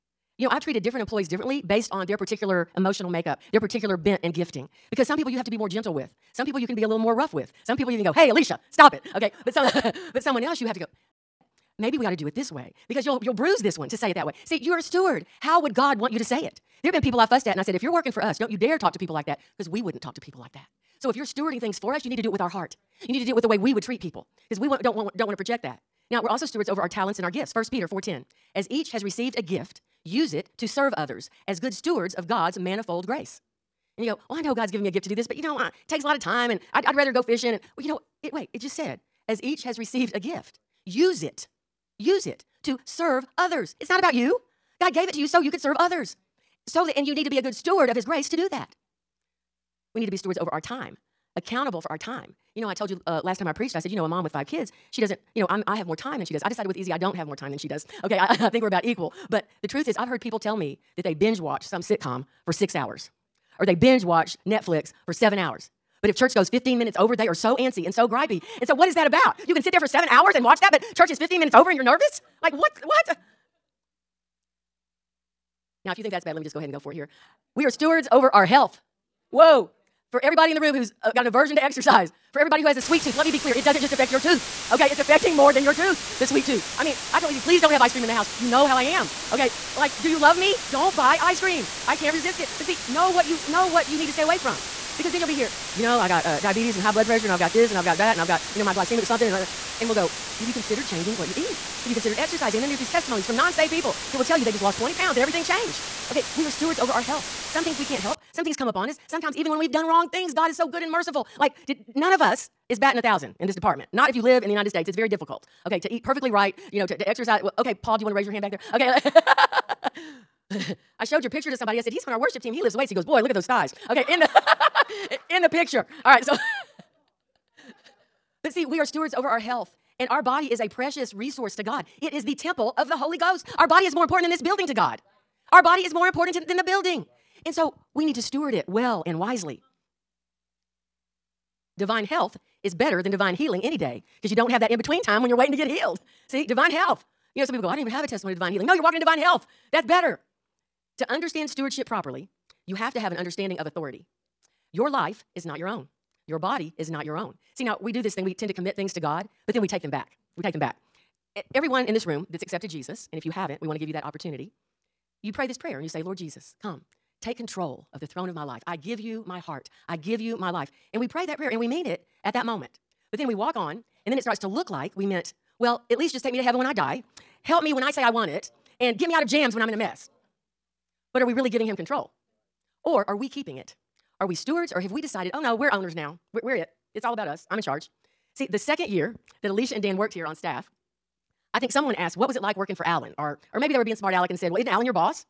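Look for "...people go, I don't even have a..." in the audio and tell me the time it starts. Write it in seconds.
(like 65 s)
147 s.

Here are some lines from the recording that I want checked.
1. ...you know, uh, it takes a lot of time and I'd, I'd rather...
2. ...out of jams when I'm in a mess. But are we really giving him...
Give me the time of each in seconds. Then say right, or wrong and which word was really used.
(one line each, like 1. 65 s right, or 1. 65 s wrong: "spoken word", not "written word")
1. 35 s right
2. 179 s right.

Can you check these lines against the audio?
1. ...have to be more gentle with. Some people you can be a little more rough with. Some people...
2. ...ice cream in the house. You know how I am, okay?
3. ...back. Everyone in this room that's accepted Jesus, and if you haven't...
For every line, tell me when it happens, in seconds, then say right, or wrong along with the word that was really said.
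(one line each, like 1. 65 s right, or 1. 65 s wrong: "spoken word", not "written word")
1. 5 s right
2. 87 s right
3. 160 s right.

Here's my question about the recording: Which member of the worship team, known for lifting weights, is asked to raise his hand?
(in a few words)
Paul.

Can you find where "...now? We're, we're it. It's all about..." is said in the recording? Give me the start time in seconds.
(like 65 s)
185 s.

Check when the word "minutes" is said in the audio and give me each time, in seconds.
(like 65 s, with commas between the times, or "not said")
66 s, 71 s.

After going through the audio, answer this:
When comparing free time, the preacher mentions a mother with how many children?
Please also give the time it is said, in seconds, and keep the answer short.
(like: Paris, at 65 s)
5, at 54 s.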